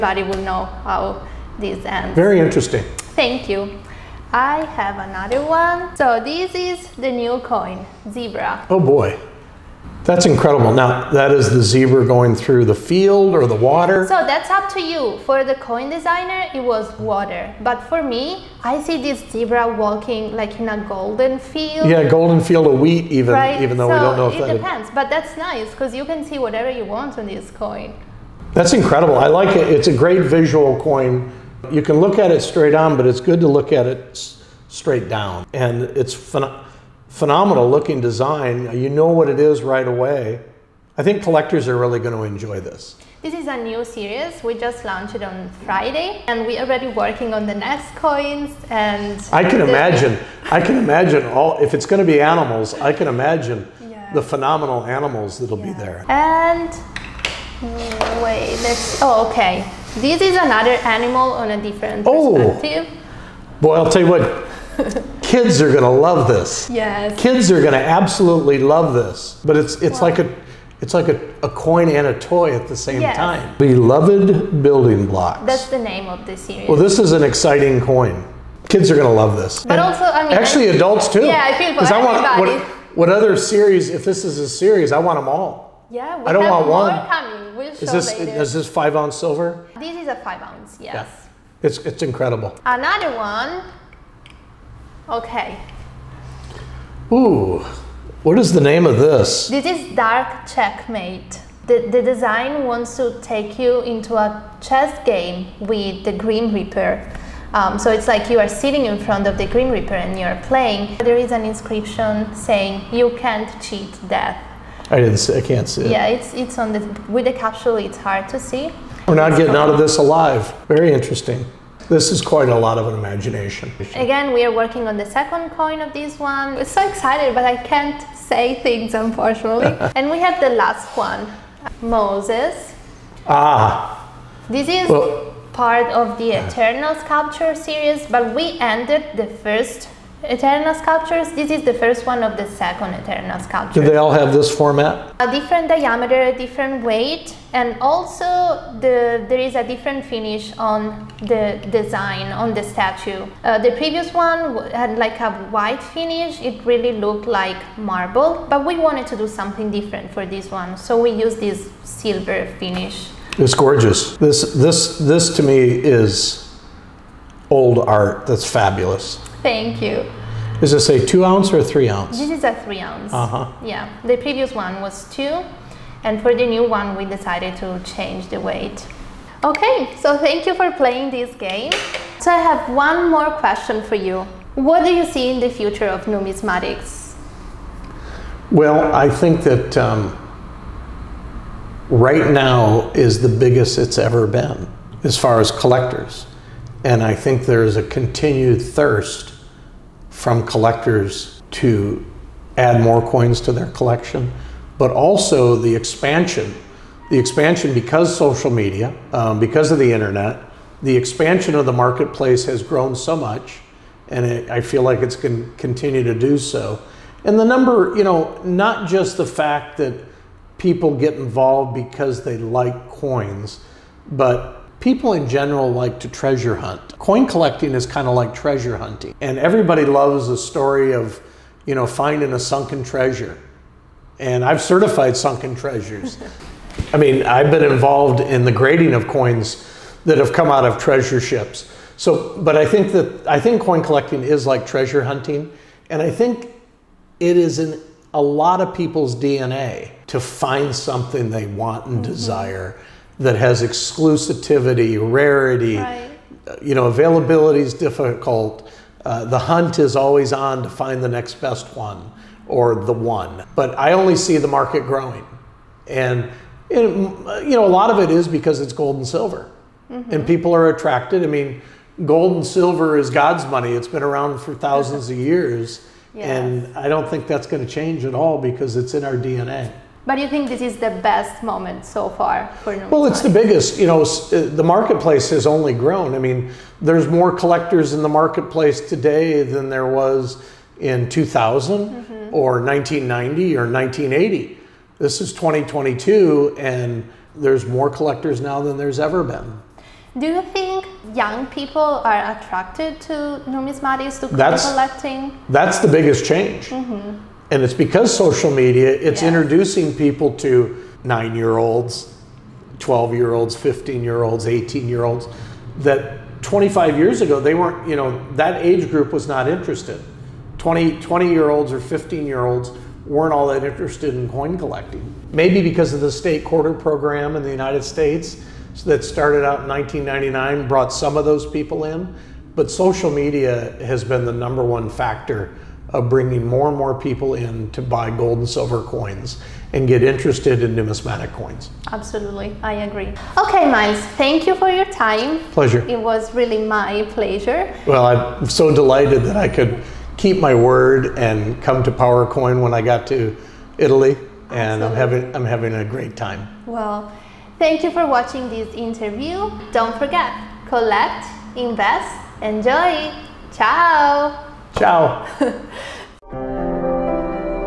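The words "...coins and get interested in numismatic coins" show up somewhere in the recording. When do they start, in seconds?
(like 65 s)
338 s.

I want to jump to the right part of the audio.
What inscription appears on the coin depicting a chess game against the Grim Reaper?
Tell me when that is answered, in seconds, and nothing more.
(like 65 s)
112 s.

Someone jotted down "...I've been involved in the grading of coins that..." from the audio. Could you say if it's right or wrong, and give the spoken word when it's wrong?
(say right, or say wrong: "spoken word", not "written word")
right.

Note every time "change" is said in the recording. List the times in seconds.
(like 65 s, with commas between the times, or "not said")
177 s, 277 s, 306 s.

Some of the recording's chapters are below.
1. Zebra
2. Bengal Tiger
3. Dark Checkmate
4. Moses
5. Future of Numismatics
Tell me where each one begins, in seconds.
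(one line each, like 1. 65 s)
1. 6 s
2. 58 s
3. 94 s
4. 131 s
5. 181 s.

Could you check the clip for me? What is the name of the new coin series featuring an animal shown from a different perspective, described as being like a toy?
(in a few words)
Beloved Building Blocks.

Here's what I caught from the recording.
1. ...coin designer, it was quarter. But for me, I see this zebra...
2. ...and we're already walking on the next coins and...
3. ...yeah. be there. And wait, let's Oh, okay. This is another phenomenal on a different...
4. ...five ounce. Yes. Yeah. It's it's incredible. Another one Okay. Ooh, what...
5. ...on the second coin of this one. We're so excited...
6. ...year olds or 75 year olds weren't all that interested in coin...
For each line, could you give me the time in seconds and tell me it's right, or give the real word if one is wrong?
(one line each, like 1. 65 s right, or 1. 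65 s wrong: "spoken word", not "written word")
1. 15 s wrong: "water", not "quarter"
2. 46 s wrong: "working", not "walking"
3. 55 s wrong: "animal", not "phenomenal"
4. 90 s right
5. 124 s right
6. 321 s wrong: "15", not "75".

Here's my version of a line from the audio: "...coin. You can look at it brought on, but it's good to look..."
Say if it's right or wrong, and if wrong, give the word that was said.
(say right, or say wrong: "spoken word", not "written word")
wrong: "straight", not "brought".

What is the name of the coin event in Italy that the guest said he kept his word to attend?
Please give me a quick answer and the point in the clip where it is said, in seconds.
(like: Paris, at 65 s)
PowerCoin, at 351 s.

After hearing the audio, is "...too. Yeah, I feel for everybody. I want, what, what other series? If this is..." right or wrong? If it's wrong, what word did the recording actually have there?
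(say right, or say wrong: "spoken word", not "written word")
right.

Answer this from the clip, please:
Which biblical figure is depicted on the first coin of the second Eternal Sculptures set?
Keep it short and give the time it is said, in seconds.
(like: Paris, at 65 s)
Moses, at 131 s.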